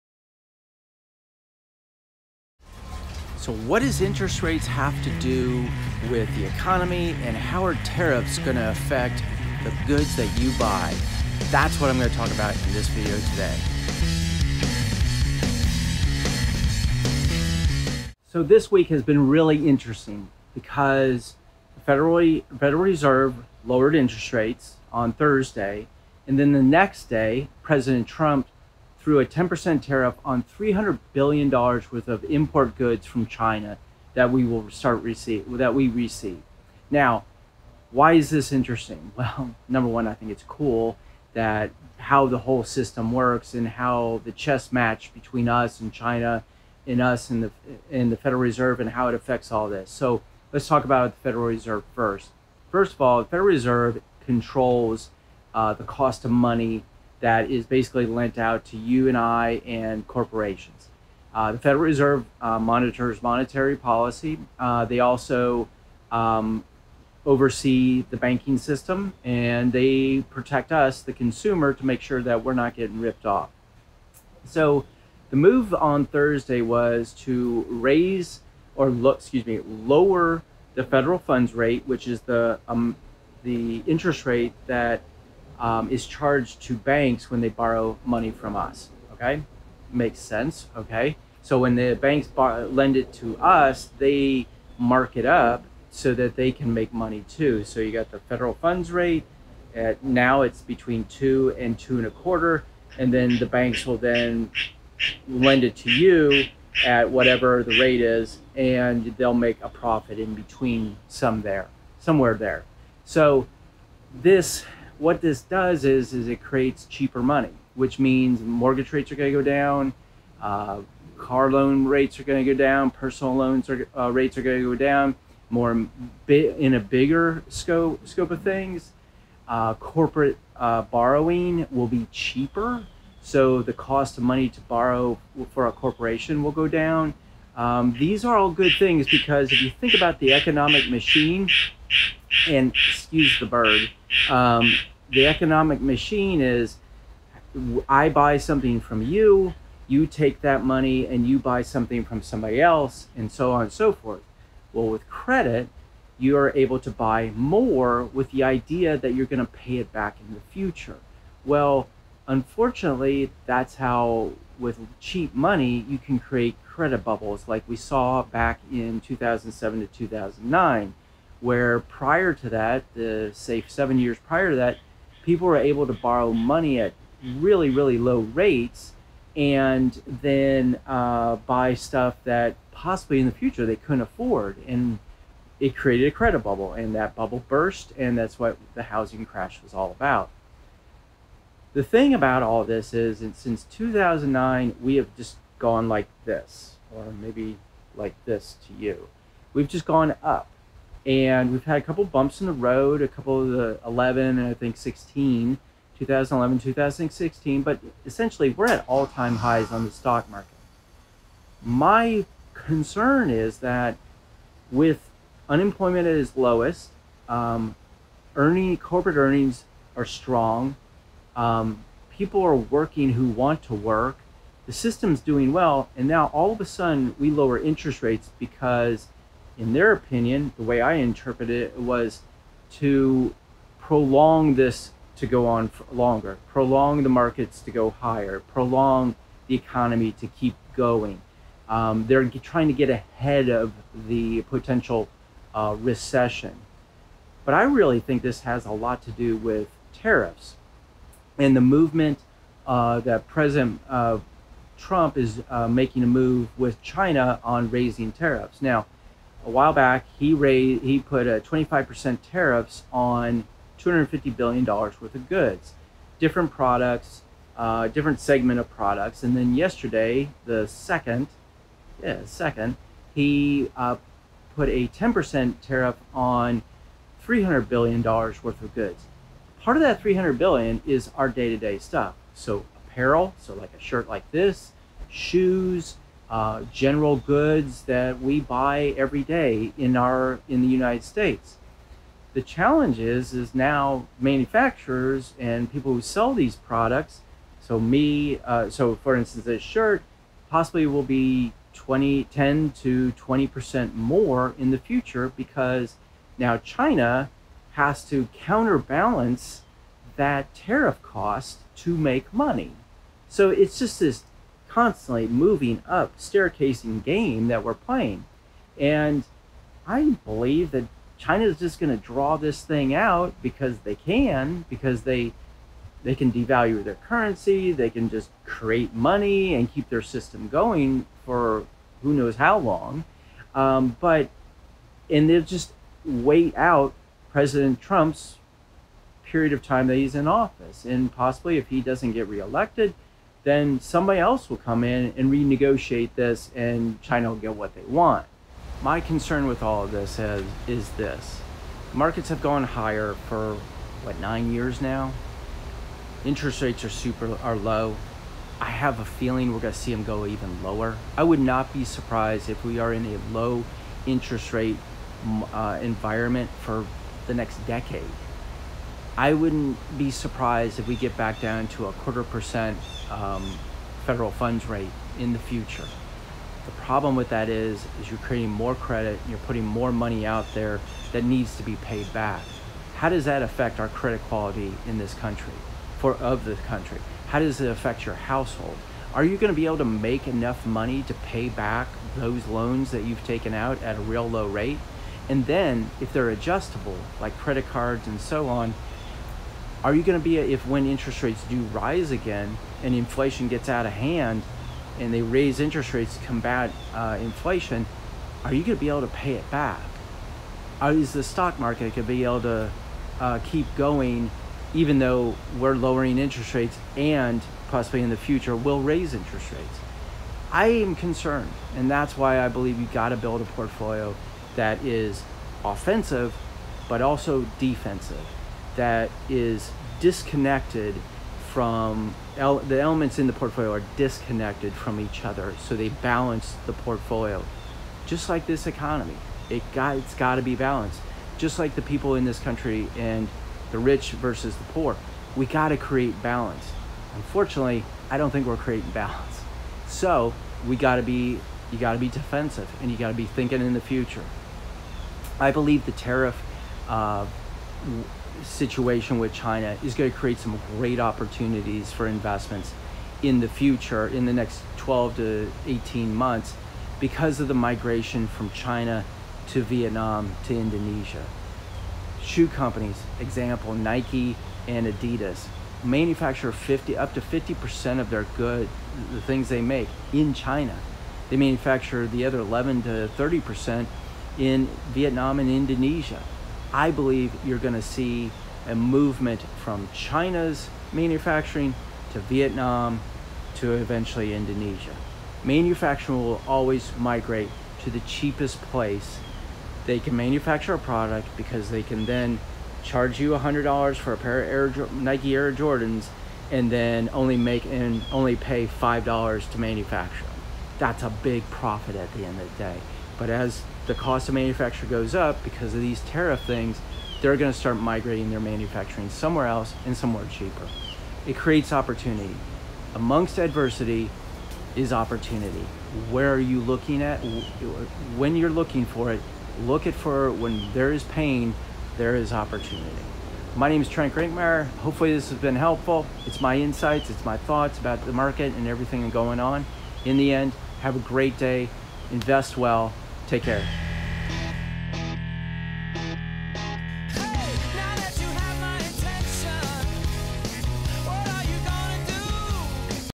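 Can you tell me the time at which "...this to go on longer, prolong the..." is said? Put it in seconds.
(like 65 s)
234 s.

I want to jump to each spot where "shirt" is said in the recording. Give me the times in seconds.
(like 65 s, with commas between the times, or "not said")
283 s, 299 s.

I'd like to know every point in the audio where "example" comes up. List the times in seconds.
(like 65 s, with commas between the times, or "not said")
473 s.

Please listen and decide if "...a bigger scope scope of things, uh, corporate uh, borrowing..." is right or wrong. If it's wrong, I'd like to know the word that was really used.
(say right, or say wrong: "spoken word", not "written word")
right.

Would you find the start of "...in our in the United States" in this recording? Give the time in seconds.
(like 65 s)
289 s.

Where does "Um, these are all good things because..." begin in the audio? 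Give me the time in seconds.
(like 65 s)
137 s.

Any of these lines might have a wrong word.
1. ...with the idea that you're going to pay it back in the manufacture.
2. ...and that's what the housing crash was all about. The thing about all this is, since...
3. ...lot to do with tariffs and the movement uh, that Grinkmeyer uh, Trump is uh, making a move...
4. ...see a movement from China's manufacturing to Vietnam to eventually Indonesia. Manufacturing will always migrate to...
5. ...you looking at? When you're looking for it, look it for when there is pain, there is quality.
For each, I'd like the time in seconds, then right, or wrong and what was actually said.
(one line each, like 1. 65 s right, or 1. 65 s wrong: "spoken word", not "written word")
1. 158 s wrong: "future", not "manufacture"
2. 187 s right
3. 248 s wrong: "President", not "Grinkmeyer"
4. 487 s right
5. 526 s wrong: "opportunity", not "quality".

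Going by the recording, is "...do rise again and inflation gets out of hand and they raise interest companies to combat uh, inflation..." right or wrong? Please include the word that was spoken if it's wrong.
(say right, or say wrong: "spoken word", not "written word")
wrong: "rates", not "companies".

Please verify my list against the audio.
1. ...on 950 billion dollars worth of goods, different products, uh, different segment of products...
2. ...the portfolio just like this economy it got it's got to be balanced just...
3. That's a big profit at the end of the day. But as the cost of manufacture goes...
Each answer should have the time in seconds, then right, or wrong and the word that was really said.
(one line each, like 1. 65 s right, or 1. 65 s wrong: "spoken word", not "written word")
1. 262 s wrong: "250", not "950"
2. 436 s right
3. 510 s right.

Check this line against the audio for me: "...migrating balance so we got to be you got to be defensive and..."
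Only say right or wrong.
wrong.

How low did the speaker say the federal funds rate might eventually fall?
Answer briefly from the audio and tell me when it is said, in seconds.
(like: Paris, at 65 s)
0.25%, at 371 s.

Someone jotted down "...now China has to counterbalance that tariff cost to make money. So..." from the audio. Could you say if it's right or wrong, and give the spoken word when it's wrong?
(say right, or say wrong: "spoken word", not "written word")
right.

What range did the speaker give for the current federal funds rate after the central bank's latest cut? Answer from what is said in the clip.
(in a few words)
2 to 2.25%.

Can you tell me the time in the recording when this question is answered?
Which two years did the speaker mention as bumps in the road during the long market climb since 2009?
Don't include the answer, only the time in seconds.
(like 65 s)
205 s.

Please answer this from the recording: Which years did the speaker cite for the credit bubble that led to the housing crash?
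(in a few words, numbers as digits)
2007 to 2009.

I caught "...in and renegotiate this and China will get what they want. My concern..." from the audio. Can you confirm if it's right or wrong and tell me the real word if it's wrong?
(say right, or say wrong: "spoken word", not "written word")
right.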